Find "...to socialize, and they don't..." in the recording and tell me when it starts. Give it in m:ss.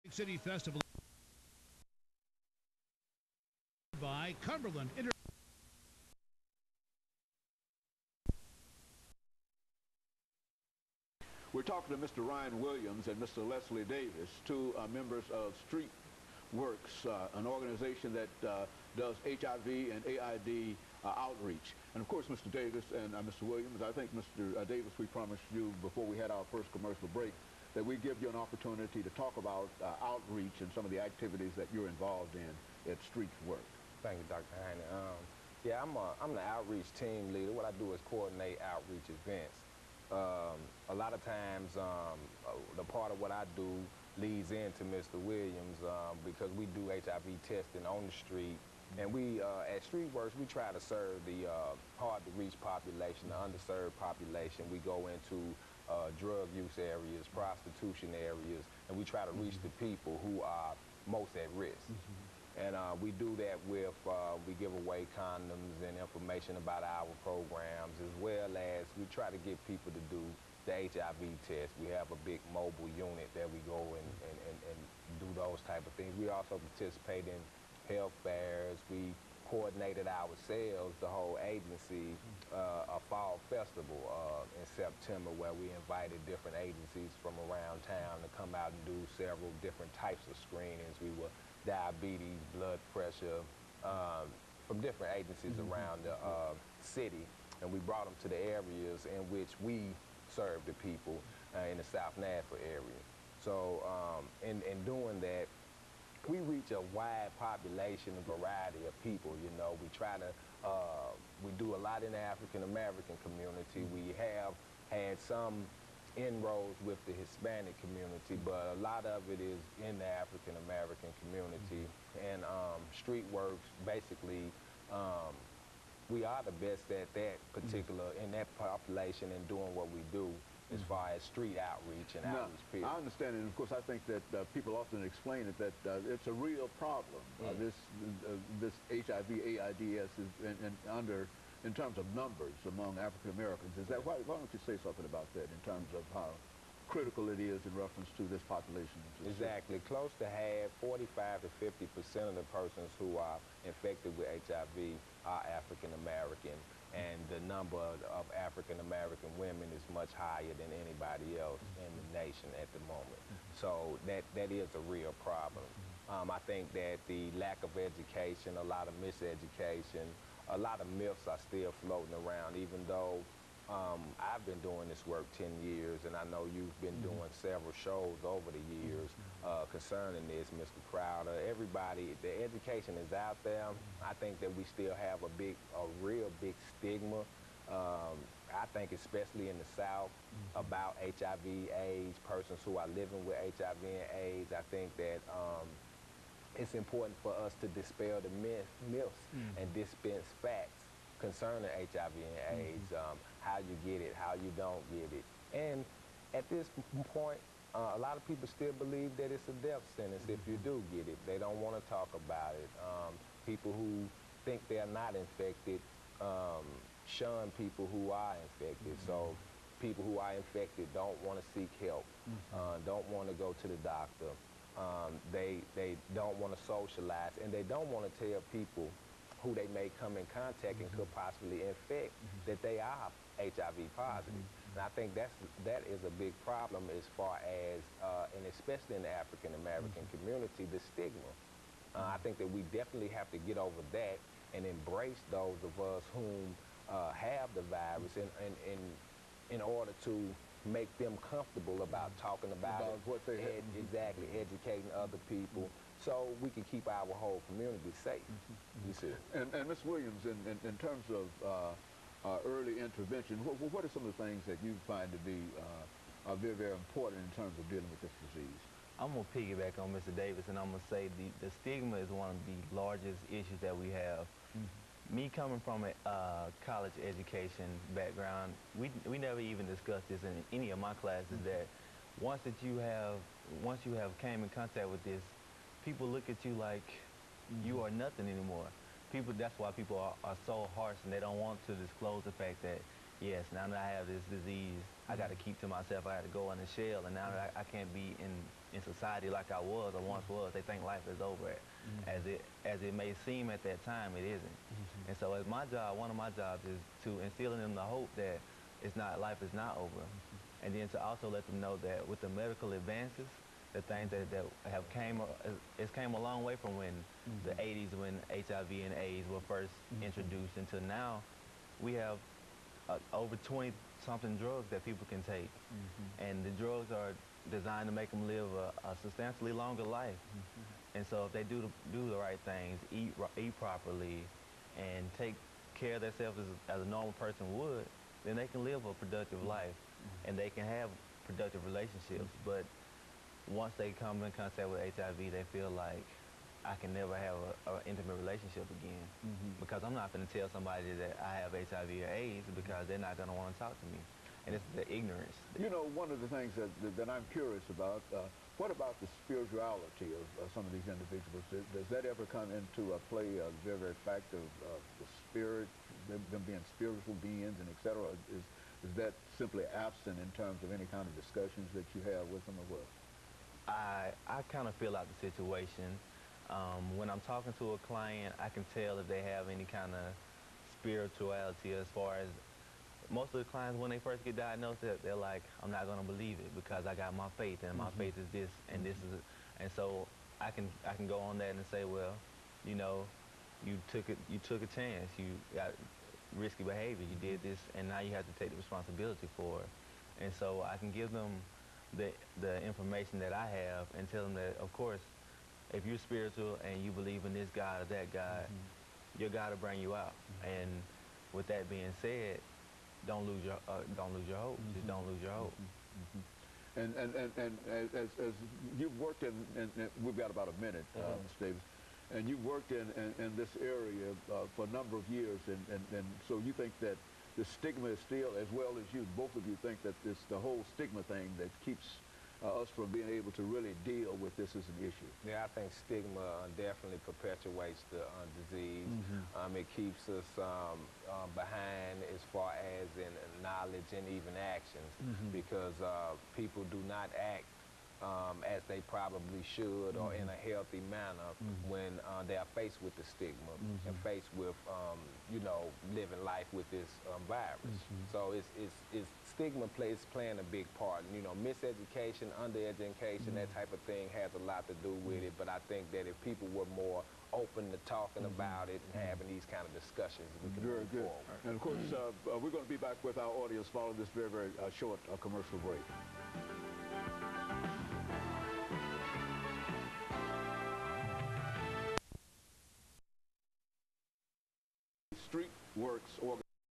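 3:46.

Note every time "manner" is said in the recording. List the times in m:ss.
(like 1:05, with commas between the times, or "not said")
7:30.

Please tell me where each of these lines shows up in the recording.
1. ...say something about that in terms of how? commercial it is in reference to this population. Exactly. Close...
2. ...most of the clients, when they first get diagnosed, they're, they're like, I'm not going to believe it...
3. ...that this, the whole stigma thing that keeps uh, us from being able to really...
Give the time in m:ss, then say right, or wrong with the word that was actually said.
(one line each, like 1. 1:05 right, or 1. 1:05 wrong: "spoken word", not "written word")
1. 2:24 wrong: "critical", not "commercial"
2. 6:23 right
3. 7:09 right.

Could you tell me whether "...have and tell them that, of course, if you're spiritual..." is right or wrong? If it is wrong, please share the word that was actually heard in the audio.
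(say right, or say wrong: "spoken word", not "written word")
right.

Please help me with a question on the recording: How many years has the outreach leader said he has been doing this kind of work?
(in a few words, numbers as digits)
10 years.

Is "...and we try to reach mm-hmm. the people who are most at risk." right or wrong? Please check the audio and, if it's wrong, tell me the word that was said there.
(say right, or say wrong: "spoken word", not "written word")
right.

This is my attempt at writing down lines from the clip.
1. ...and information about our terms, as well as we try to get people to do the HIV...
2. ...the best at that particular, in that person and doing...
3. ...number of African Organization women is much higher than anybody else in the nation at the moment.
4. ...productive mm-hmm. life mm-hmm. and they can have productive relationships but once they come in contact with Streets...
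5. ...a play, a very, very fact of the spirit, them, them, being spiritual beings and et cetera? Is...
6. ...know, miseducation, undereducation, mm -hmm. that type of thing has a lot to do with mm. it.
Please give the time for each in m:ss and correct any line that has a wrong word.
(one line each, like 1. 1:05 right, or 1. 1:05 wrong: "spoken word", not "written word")
1. 1:05 wrong: "programs", not "terms"
2. 2:06 wrong: "population", not "person"
3. 2:37 wrong: "American", not "Organization"
4. 5:38 wrong: "HIV", not "Streets"
5. 6:02 right
6. 7:41 right.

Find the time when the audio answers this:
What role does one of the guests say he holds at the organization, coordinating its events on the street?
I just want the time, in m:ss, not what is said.
0:36.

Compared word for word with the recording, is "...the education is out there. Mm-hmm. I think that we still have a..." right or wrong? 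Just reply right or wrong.
right.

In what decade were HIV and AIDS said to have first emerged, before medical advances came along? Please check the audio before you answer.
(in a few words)
The 80s.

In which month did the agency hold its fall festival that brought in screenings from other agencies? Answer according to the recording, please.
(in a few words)
September.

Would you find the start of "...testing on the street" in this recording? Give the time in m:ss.
0:47.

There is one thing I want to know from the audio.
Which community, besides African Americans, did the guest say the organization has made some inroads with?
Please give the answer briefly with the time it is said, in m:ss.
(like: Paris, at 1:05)
Hispanic community, at 1:57.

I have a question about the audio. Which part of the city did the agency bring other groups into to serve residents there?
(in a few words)
South Nashville.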